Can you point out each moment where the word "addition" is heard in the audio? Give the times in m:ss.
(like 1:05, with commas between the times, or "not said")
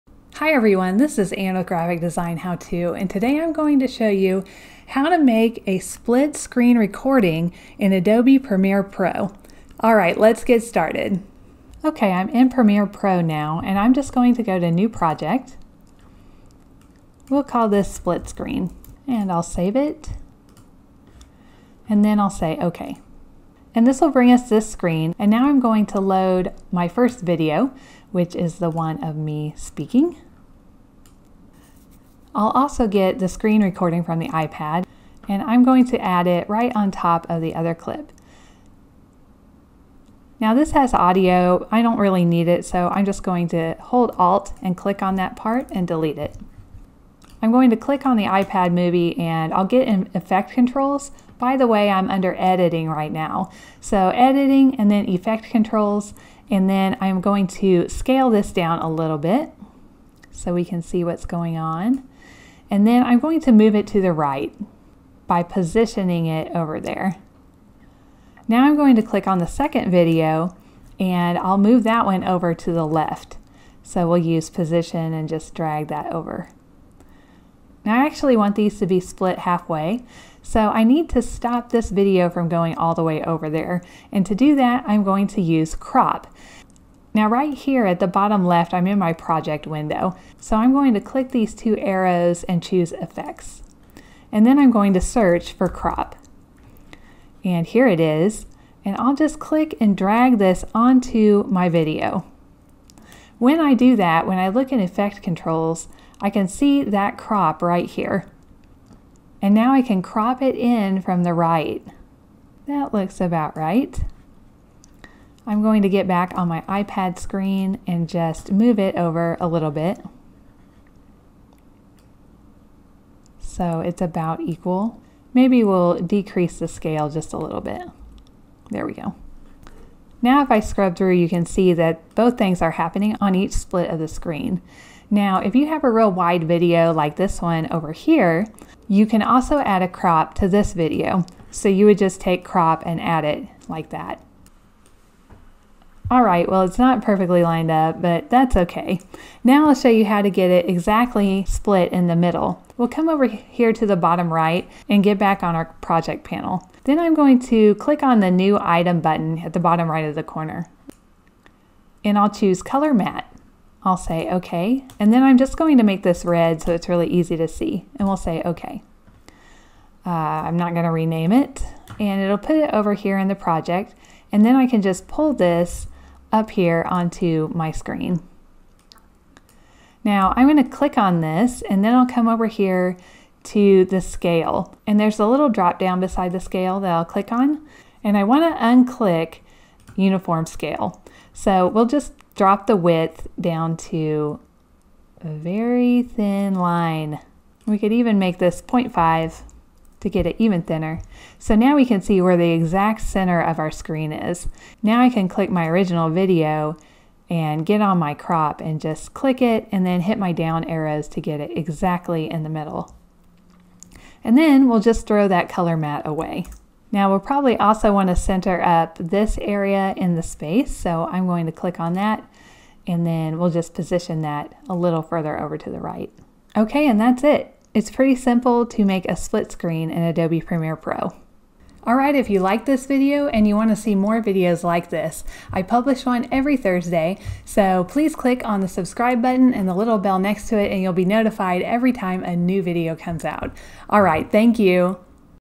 not said.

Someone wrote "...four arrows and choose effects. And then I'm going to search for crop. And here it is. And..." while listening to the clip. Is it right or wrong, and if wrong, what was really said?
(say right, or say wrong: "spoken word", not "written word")
wrong: "two", not "four".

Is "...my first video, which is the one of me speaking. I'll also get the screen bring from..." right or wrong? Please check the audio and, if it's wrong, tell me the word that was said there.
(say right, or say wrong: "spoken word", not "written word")
wrong: "recording", not "bring".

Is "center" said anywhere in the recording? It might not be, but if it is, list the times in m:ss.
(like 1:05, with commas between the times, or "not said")
3:23, 3:38.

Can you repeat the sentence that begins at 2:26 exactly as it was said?
All right, well, it's not perfectly lined up, but that's okay.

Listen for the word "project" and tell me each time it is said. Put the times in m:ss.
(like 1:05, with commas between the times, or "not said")
0:14, 1:29, 2:35, 2:53.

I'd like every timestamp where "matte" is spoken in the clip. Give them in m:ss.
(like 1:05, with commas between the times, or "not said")
2:42, 3:35.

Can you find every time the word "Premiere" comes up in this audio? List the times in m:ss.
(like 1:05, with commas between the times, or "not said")
0:08, 0:12, 3:50.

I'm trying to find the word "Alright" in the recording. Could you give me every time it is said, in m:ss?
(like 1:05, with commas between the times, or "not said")
3:51, 4:03.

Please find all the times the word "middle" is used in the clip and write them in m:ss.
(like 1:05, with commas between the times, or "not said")
2:32, 3:32.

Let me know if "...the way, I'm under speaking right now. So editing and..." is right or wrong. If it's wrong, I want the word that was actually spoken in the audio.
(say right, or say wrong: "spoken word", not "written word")
wrong: "editing", not "speaking".